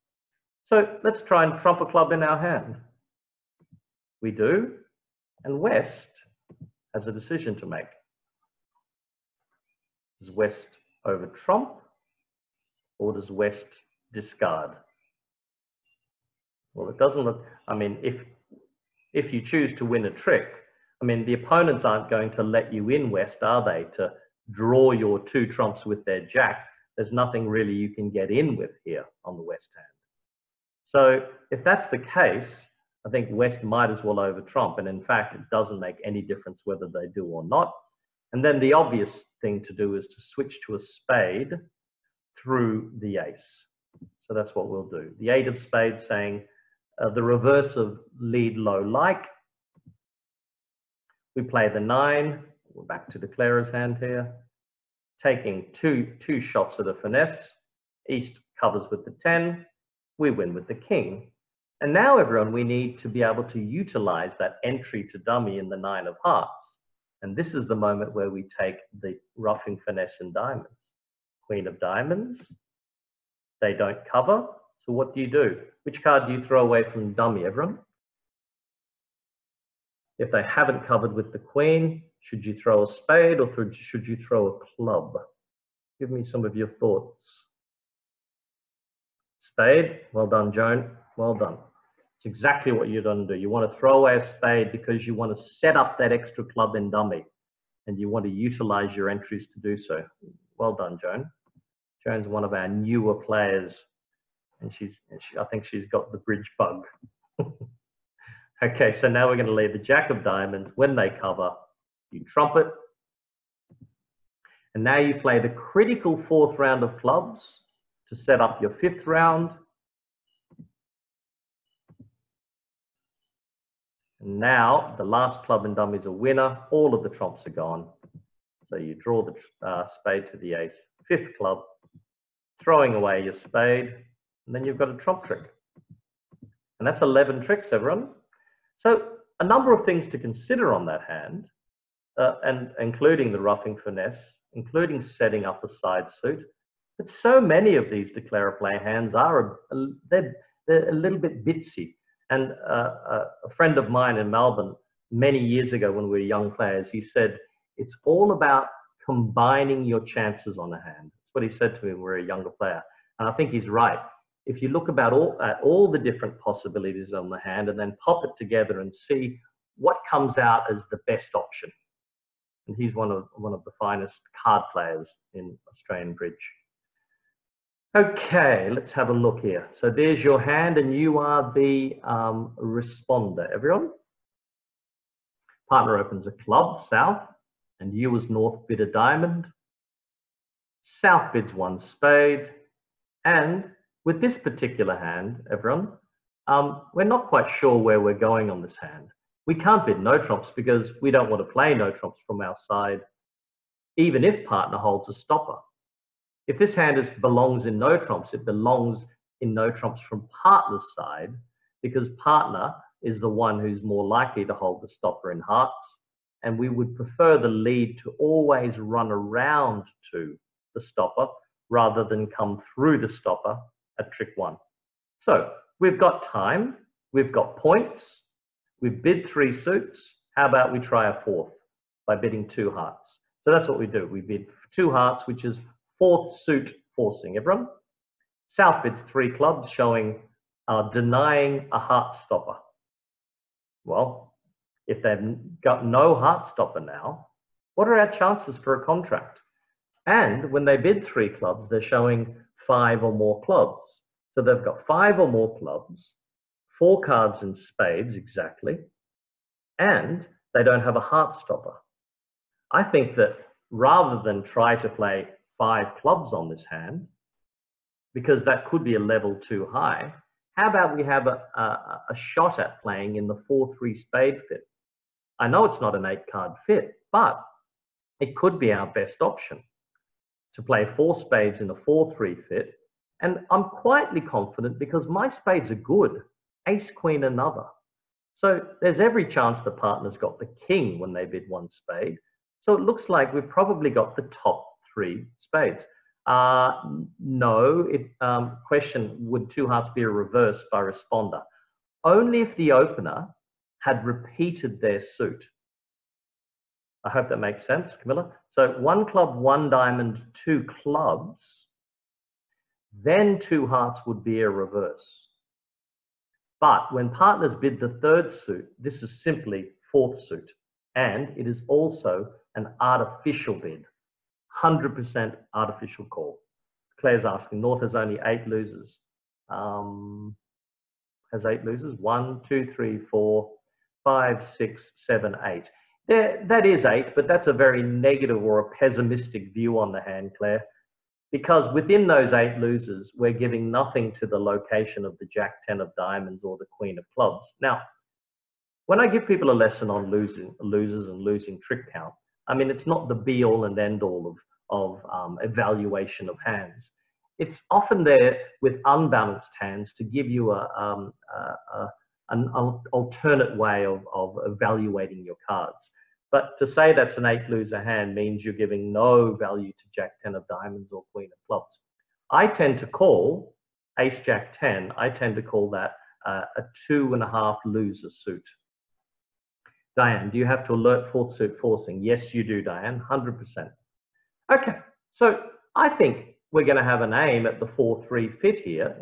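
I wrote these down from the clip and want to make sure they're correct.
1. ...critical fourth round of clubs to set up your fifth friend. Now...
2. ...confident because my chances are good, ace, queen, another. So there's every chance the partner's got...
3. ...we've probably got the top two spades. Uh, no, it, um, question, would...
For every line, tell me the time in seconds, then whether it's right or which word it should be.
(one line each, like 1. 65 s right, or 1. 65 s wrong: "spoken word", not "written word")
1. 115 s wrong: "round", not "friend"
2. 284 s wrong: "spades", not "chances"
3. 293 s wrong: "three", not "two".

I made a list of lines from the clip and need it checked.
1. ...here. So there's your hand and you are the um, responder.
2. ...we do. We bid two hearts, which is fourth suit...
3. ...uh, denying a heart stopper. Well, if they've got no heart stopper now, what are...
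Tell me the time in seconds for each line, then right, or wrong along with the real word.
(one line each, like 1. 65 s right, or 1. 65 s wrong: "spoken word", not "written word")
1. 179 s right
2. 233 s right
3. 240 s right.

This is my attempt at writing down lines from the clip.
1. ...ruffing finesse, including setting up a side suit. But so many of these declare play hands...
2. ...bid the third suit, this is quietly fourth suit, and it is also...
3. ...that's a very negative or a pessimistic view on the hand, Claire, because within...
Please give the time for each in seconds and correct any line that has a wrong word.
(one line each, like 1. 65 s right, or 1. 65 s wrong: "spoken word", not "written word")
1. 143 s right
2. 317 s wrong: "simply", not "quietly"
3. 337 s right.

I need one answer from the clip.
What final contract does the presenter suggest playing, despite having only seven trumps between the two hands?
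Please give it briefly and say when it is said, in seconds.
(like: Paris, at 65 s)
Four spades, at 280 s.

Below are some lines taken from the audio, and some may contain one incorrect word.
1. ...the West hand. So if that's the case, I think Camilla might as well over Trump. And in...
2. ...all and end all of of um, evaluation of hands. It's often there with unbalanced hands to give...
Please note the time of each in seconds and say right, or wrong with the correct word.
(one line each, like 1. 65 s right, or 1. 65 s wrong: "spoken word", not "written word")
1. 29 s wrong: "West", not "Camilla"
2. 353 s right.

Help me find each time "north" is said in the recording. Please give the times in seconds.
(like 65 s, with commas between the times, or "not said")
188 s, 327 s.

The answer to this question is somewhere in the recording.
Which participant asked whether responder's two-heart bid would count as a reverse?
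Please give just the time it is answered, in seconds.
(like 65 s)
308 s.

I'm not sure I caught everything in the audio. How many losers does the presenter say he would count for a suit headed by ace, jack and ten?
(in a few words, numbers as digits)
2.5.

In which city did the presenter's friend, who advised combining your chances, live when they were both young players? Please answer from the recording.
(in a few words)
Melbourne.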